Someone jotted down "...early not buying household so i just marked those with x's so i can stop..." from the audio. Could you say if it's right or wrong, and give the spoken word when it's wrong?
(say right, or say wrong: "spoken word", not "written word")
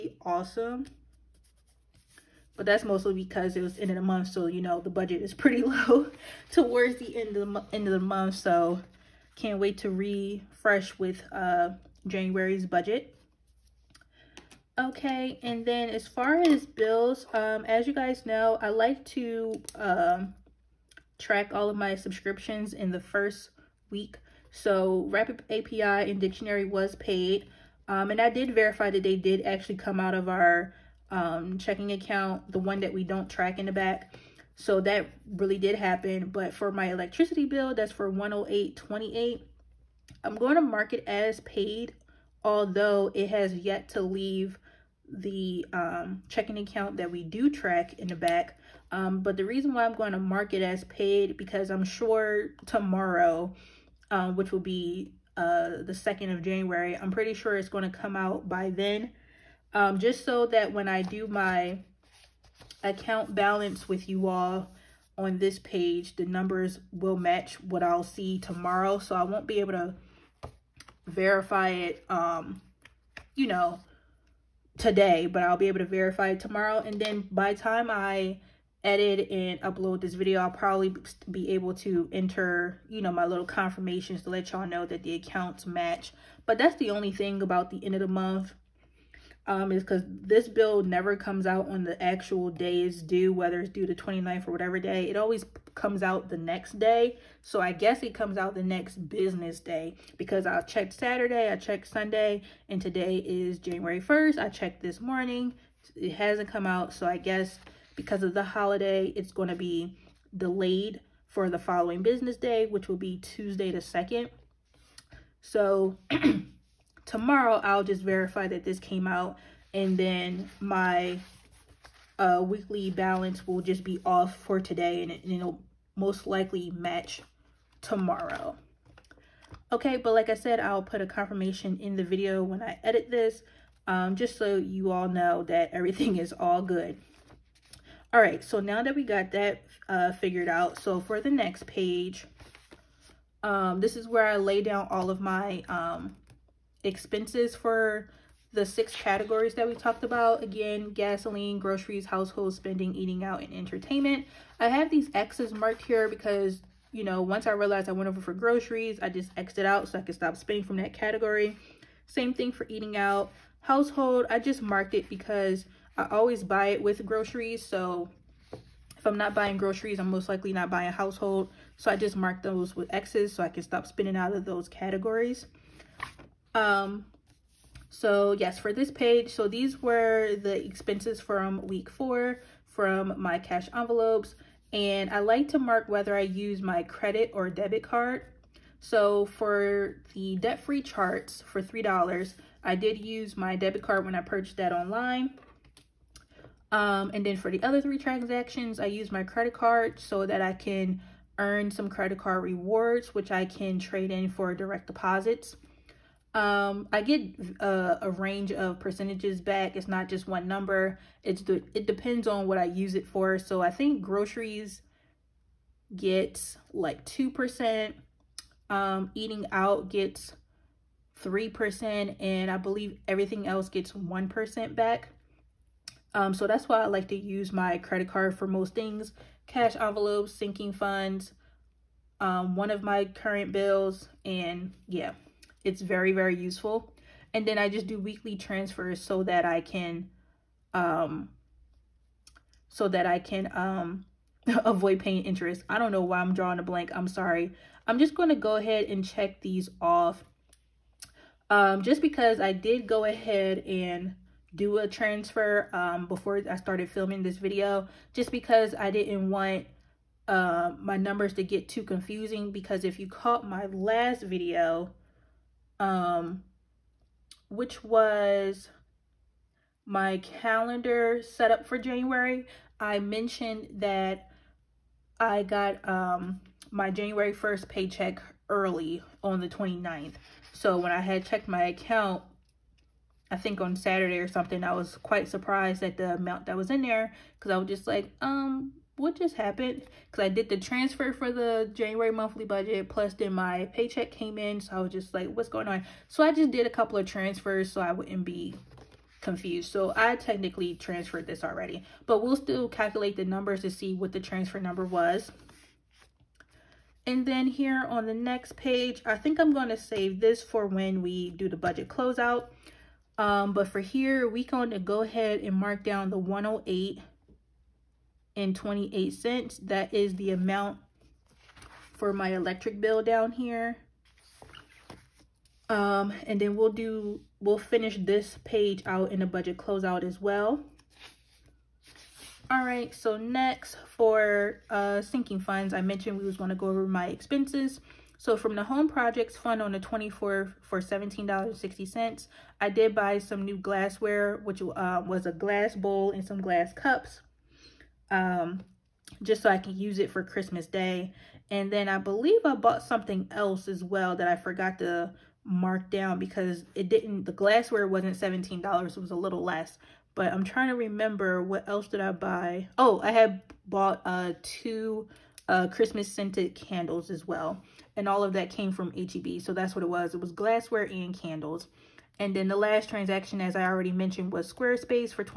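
wrong: "likely", not "early".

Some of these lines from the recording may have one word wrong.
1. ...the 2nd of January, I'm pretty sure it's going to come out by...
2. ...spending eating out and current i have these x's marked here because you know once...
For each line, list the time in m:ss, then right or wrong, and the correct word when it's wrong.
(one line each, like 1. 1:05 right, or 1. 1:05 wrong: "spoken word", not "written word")
1. 0:55 right
2. 2:32 wrong: "entertainment", not "current".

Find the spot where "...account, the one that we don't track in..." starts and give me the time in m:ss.
0:31.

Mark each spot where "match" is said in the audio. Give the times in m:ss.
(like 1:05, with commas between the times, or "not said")
1:07, 1:25, 2:06.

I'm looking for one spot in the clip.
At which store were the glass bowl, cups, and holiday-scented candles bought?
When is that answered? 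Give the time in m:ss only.
6:08.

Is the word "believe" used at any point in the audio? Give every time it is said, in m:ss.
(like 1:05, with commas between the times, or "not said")
3:42, 5:51.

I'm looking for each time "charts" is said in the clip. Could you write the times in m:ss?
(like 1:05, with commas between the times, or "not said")
3:10.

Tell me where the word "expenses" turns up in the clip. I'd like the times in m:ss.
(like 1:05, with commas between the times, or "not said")
2:26, 3:00, 5:37.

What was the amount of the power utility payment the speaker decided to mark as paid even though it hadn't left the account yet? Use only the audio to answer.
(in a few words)
$108.28.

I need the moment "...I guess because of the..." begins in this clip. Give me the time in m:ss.
1:47.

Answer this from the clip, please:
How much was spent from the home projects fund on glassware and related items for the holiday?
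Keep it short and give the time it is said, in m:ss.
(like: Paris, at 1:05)
$17.60, at 5:40.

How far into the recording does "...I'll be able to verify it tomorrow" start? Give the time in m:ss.
1:15.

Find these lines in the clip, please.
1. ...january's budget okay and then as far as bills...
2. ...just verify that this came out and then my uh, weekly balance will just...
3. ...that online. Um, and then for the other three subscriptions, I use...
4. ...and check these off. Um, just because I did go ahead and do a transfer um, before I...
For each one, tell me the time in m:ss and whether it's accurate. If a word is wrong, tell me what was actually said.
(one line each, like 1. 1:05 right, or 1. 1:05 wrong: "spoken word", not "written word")
1. 0:12 right
2. 1:57 right
3. 3:14 wrong: "transactions", not "subscriptions"
4. 4:08 right.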